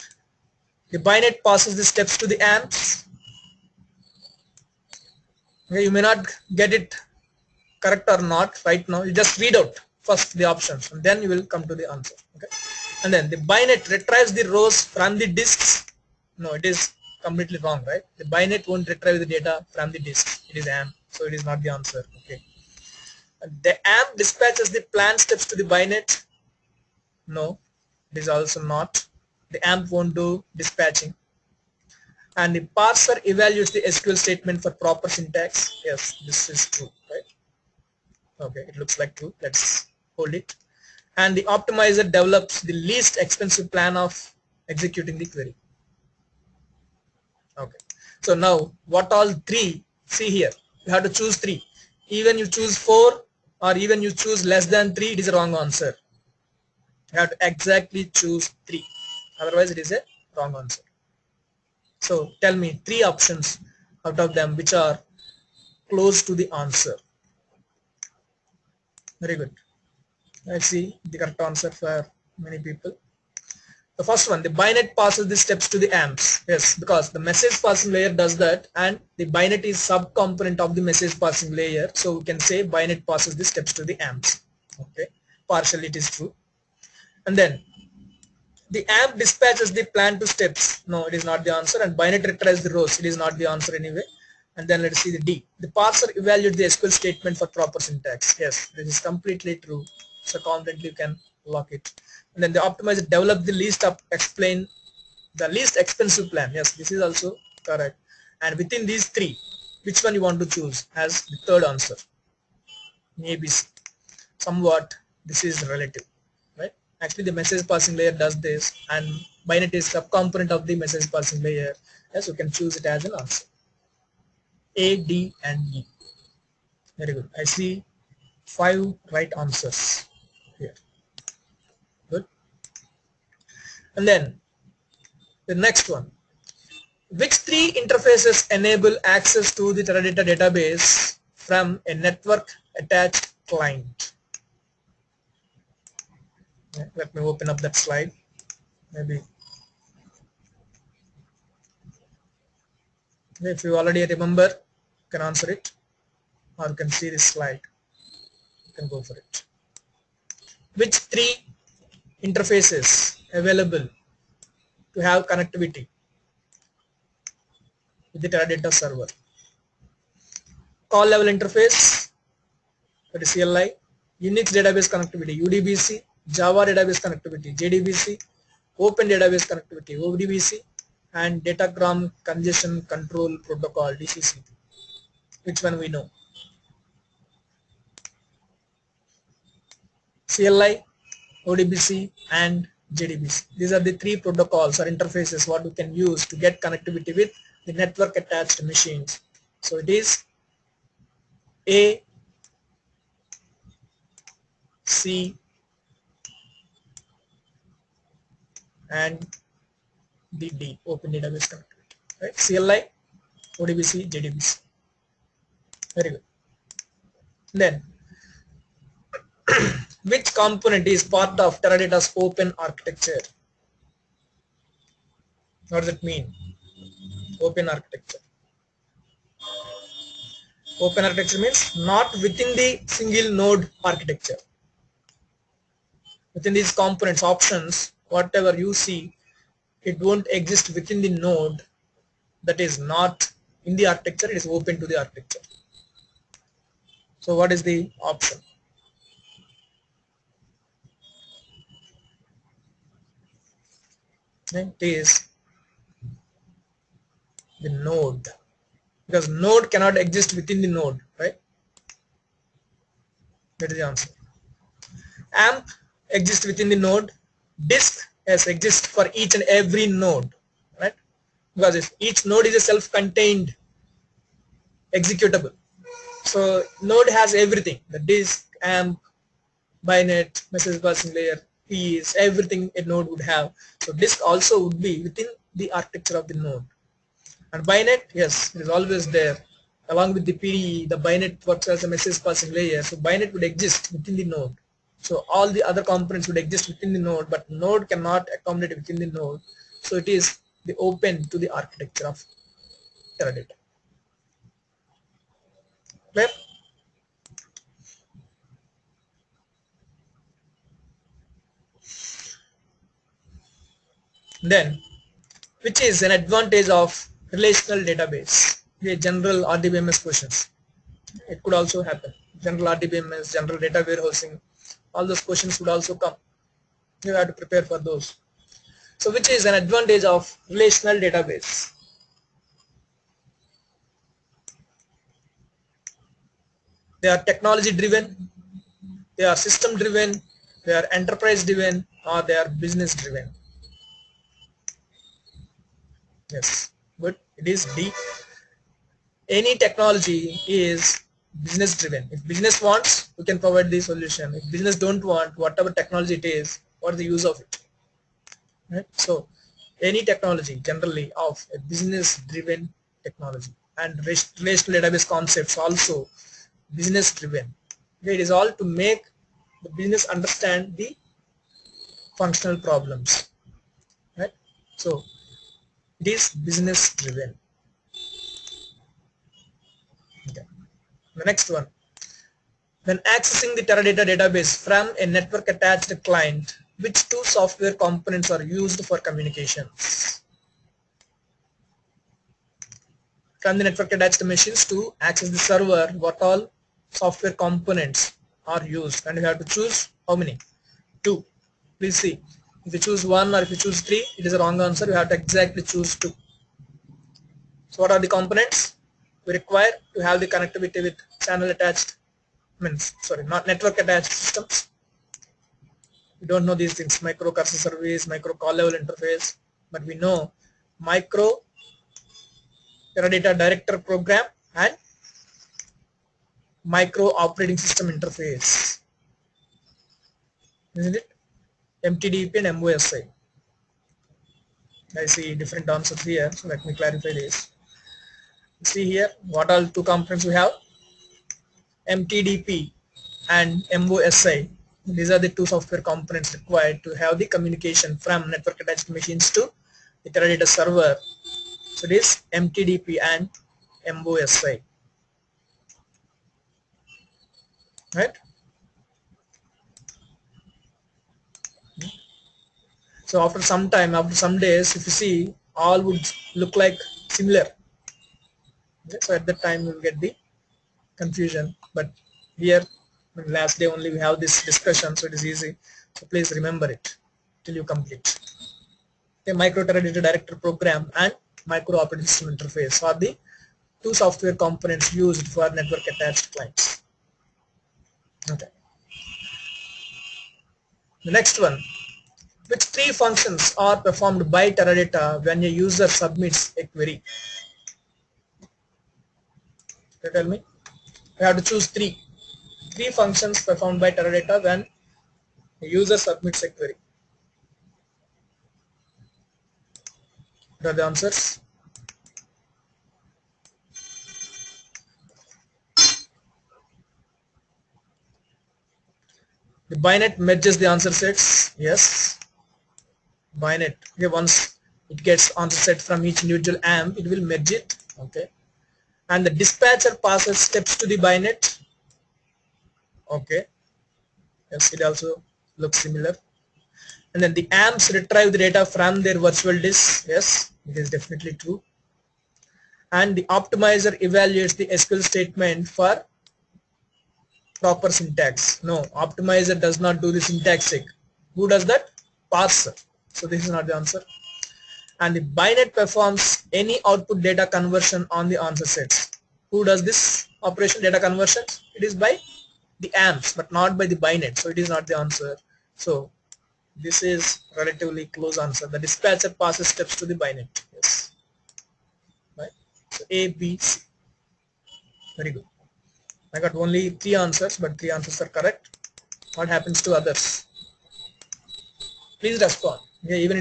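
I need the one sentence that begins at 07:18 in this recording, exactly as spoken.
See here, what are two components we have?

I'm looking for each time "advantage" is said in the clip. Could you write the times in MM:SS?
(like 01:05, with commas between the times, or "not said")
05:16, 05:29.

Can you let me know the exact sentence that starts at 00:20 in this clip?
It is amps so it is not the answer okay the amp dispatches the plan steps to the bynet.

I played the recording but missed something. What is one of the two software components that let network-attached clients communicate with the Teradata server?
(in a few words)
Micro Teradata Director Program.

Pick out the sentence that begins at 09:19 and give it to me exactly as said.
Who does this operation data conversions?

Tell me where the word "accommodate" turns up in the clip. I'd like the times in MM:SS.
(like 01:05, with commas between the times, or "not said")
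04:58.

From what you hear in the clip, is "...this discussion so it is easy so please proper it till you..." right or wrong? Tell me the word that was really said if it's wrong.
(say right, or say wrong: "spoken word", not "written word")
wrong: "remember", not "proper".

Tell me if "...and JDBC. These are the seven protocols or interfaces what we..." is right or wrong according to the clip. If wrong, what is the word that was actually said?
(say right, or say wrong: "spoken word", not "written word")
wrong: "three", not "seven".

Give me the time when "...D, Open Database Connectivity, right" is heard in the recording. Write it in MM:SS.
03:30.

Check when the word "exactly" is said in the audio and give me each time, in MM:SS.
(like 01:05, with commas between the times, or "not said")
00:57, 06:45.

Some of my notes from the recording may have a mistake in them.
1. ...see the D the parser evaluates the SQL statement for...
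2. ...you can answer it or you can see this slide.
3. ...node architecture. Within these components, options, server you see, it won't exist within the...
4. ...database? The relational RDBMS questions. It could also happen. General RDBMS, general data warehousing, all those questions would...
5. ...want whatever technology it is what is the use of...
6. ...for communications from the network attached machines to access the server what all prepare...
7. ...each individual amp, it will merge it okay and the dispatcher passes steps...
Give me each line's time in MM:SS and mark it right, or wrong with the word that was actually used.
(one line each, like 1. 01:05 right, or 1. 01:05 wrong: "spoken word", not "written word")
1. 01:35 right
2. 02:34 right
3. 03:53 wrong: "whatever", not "server"
4. 05:17 wrong: "general", not "relational"
5. 05:55 right
6. 06:28 wrong: "software", not "prepare"
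7. 08:46 right.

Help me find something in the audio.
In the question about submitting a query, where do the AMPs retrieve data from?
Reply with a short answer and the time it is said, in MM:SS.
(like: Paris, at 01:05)
Their virtual disk, at 08:59.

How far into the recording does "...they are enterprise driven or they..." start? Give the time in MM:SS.
05:40.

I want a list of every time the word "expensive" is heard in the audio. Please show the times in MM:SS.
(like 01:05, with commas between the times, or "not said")
00:43, 01:45.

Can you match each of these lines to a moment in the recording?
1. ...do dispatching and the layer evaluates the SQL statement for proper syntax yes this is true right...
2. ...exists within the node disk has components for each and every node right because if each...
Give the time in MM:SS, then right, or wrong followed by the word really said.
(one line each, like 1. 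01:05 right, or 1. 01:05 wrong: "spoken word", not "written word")
1. 00:30 wrong: "parser", not "layer"
2. 04:26 wrong: "exists", not "components".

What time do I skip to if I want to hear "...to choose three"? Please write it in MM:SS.
08:21.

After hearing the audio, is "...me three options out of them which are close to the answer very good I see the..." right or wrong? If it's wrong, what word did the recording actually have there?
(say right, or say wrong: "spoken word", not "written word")
right.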